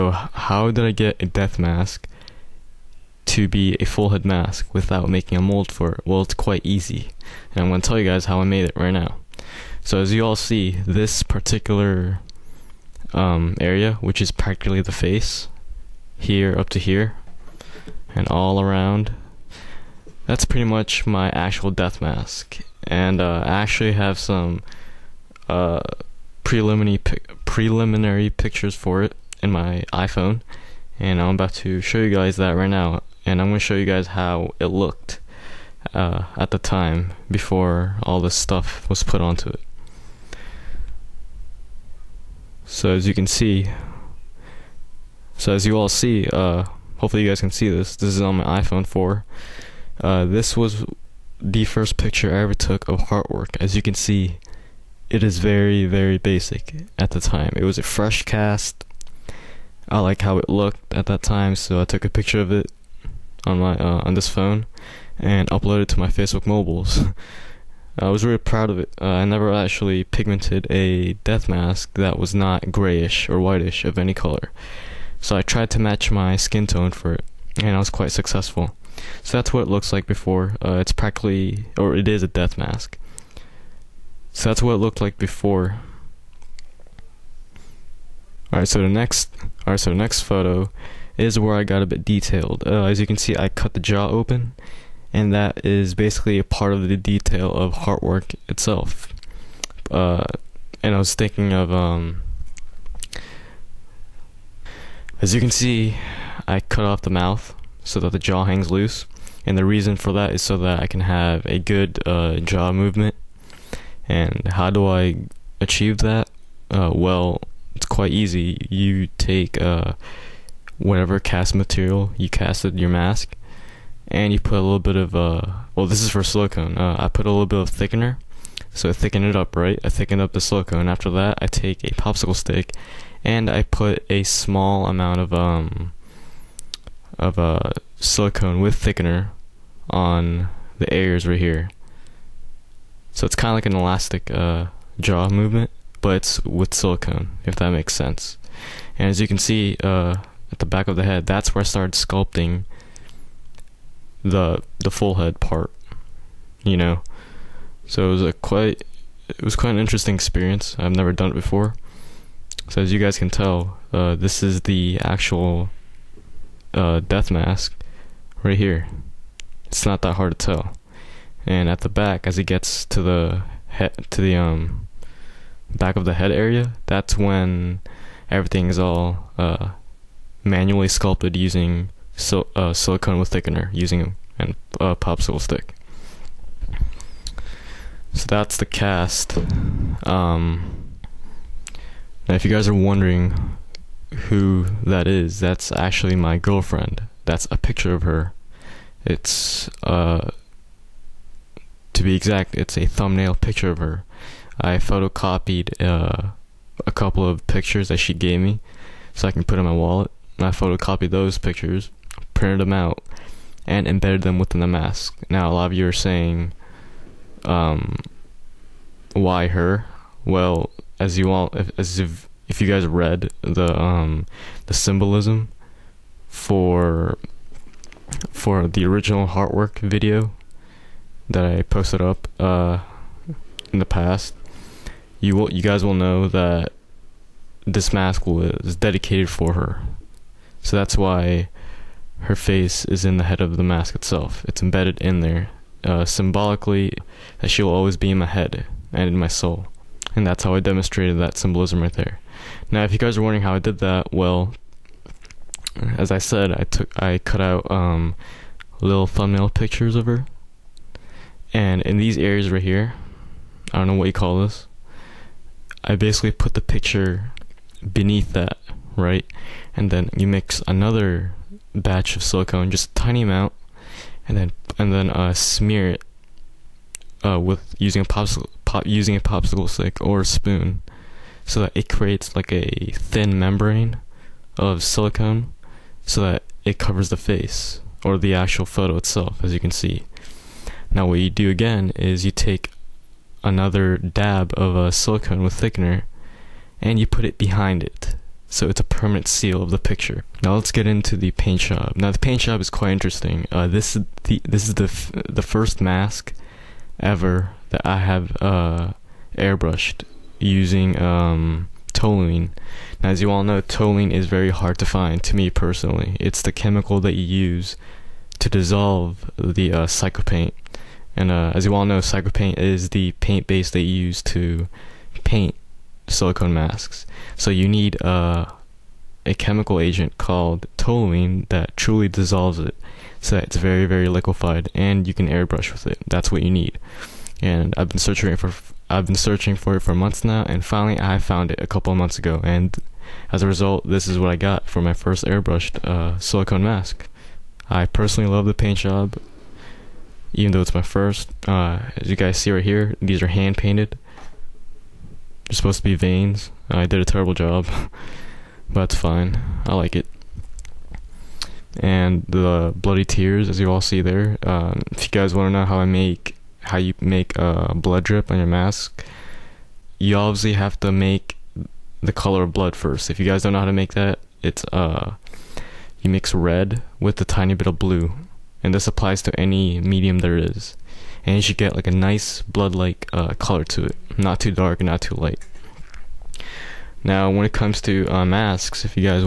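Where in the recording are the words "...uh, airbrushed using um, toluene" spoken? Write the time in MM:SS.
05:08.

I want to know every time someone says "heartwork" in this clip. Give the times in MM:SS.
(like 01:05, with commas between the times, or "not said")
00:53, 01:37, 03:49.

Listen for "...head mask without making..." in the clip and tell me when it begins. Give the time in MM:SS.
00:04.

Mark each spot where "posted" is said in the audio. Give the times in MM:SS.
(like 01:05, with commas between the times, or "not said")
03:51.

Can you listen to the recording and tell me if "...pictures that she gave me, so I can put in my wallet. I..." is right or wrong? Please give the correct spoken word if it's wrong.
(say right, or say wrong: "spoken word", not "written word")
right.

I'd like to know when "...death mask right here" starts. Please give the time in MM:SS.
02:47.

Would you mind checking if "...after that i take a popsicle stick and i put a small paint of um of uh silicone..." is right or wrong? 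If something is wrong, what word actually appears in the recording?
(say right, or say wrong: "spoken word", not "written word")
wrong: "amount", not "paint".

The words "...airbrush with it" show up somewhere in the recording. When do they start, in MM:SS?
05:35.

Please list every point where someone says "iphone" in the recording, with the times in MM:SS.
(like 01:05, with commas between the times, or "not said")
00:29, 00:48.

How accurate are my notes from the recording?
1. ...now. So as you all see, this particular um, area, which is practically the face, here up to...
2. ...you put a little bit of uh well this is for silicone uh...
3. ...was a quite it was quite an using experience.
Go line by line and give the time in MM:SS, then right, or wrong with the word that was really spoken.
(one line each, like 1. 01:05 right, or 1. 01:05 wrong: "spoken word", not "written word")
1. 00:08 right
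2. 02:04 right
3. 02:38 wrong: "interesting", not "using".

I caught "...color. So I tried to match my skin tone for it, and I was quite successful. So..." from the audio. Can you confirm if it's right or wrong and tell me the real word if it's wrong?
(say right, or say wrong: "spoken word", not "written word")
right.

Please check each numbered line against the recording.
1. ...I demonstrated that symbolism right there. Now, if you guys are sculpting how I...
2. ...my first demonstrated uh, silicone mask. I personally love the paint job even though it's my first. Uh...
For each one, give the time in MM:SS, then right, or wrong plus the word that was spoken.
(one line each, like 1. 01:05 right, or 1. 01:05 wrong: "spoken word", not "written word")
1. 04:10 wrong: "wondering", not "sculpting"
2. 05:44 wrong: "airbrushed", not "demonstrated".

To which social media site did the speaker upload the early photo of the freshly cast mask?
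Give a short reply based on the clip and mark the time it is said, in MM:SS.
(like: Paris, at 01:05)
Facebook, at 01:06.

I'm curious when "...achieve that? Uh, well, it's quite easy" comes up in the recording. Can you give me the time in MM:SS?
01:55.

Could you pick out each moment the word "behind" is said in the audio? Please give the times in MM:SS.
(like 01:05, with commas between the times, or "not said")
04:57.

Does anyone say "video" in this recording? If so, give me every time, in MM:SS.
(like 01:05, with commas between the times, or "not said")
03:49.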